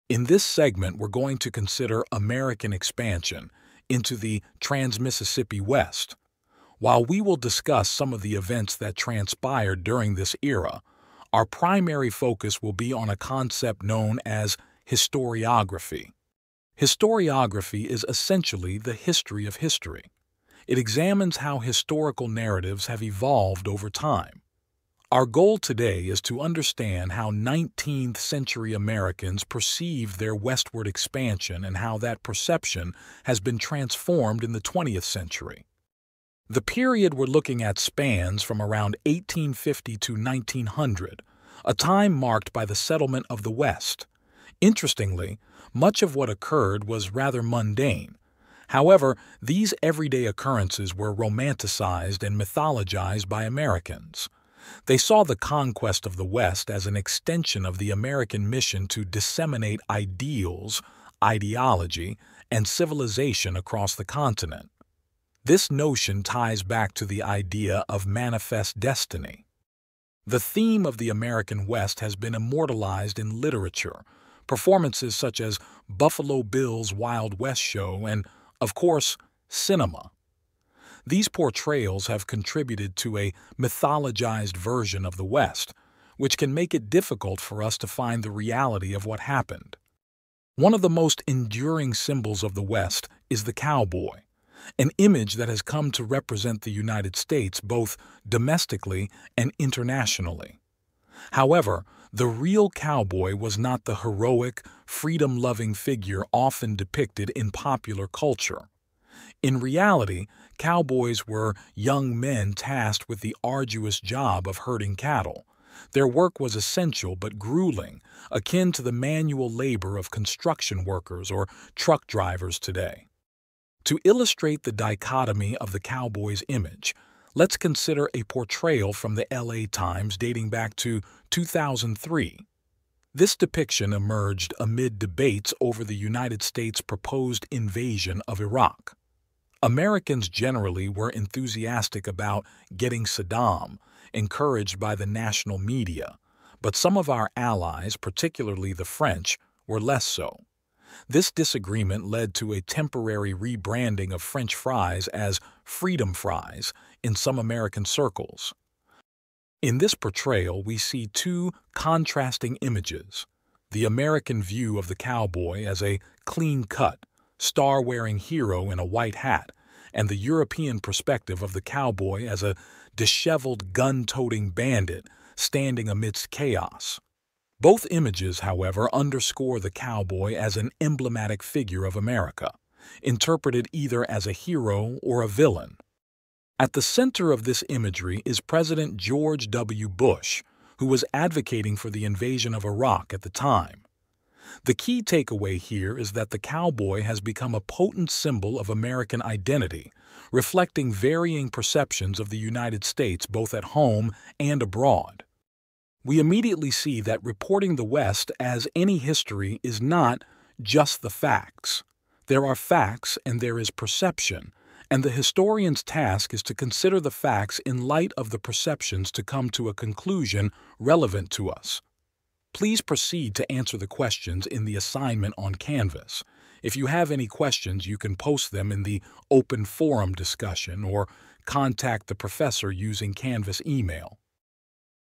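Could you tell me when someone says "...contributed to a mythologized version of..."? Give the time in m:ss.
1:22.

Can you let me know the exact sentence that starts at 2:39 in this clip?
In this portrayal, we see two contrasting images.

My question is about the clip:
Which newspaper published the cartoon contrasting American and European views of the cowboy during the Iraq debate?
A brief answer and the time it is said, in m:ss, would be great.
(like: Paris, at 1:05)
LA Times, at 2:09.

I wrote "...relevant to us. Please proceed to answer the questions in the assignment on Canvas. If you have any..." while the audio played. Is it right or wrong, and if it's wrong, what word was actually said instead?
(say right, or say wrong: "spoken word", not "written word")
right.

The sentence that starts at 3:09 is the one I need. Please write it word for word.
Bush, who was advocating for the invasion of Iraq at the time.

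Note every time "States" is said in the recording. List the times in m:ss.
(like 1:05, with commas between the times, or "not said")
1:37, 2:16, 3:22.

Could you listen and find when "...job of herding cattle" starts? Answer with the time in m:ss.
1:53.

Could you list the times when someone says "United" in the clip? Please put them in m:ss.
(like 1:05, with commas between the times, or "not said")
1:36, 2:15, 3:22.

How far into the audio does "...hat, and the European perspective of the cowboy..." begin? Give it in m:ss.
2:49.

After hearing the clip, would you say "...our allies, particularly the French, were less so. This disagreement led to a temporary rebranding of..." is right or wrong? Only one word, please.
right.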